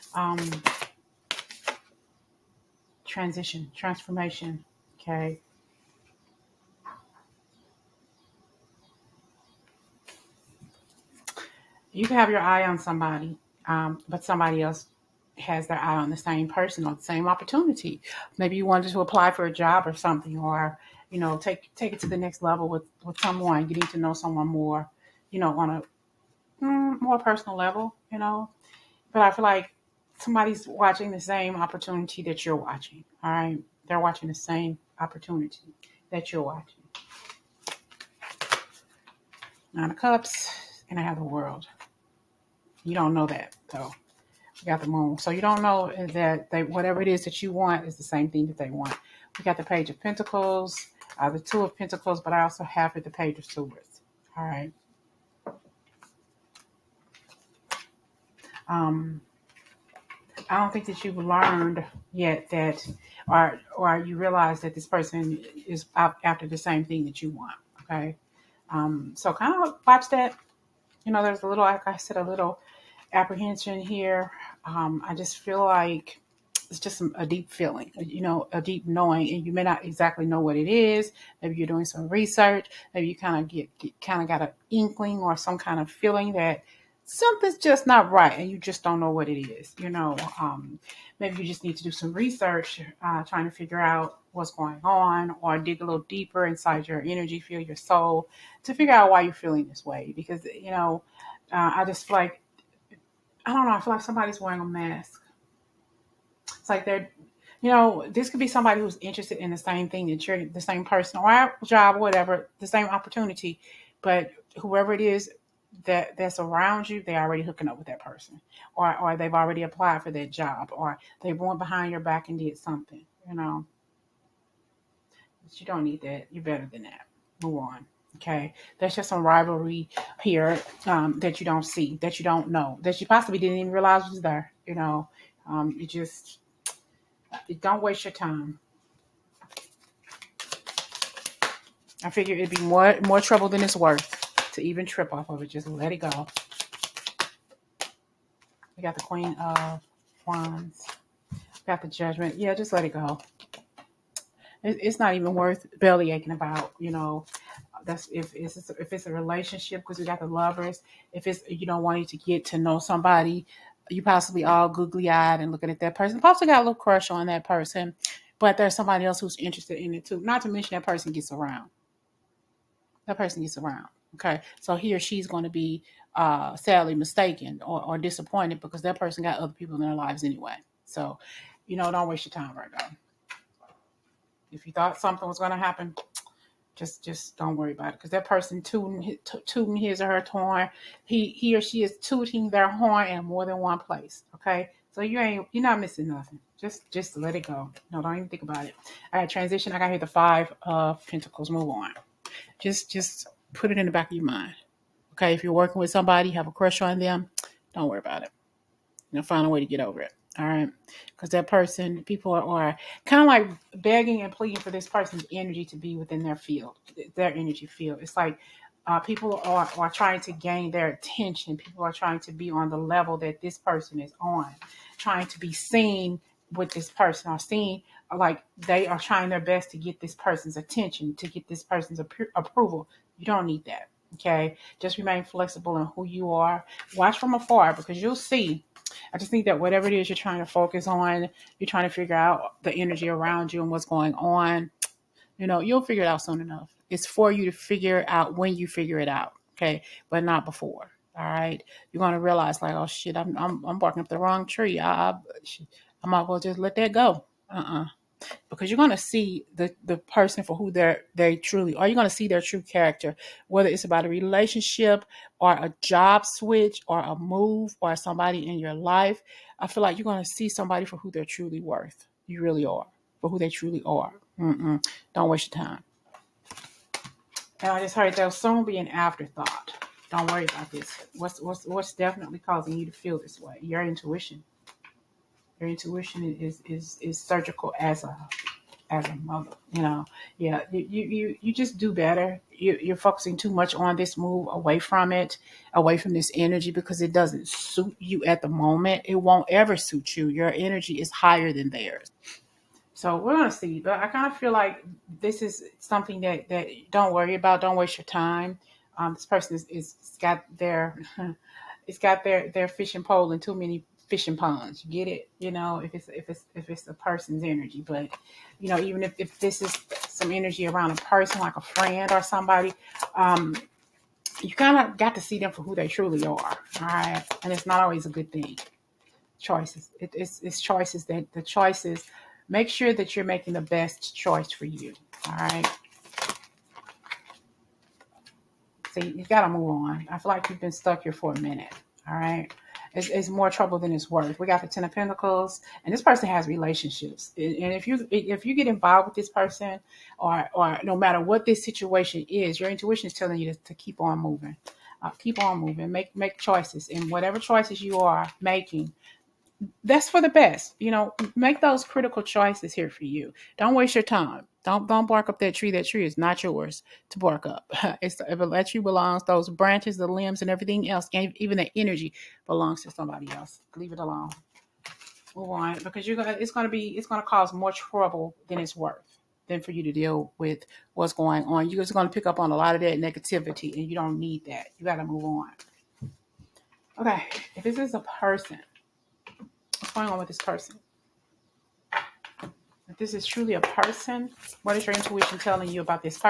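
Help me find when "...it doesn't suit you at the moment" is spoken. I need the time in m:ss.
4:56.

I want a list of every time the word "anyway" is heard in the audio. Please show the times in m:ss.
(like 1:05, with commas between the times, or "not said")
3:00.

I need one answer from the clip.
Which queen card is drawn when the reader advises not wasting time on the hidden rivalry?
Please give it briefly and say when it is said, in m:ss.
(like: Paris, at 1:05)
Queen of Wands, at 2:29.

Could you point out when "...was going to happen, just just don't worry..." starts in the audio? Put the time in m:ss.
3:05.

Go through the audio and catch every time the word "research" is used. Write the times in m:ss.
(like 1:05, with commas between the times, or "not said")
1:22, 1:32.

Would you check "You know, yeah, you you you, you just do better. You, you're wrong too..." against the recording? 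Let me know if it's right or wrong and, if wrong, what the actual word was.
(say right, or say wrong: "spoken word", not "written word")
wrong: "focusing", not "wrong".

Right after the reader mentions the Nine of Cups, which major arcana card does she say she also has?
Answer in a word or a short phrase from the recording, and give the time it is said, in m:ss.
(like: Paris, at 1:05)
The World, at 0:41.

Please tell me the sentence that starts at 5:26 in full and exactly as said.
All right, and it's not always a good thing.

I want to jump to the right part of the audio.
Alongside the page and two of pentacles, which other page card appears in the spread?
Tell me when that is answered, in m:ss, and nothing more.
0:53.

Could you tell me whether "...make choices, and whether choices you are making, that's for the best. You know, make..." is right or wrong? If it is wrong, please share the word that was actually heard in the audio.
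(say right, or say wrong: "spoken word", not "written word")
wrong: "whatever", not "whether".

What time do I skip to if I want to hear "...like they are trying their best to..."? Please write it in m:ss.
3:48.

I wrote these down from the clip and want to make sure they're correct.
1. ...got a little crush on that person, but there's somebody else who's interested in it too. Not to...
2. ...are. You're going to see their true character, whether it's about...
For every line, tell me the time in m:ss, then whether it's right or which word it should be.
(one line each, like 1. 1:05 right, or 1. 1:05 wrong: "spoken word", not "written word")
1. 2:46 right
2. 4:21 right.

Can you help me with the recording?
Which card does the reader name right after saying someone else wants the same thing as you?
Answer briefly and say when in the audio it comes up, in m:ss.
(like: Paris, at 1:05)
The Moon, at 0:44.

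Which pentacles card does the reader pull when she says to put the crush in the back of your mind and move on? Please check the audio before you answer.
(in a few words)
Five of Pentacles.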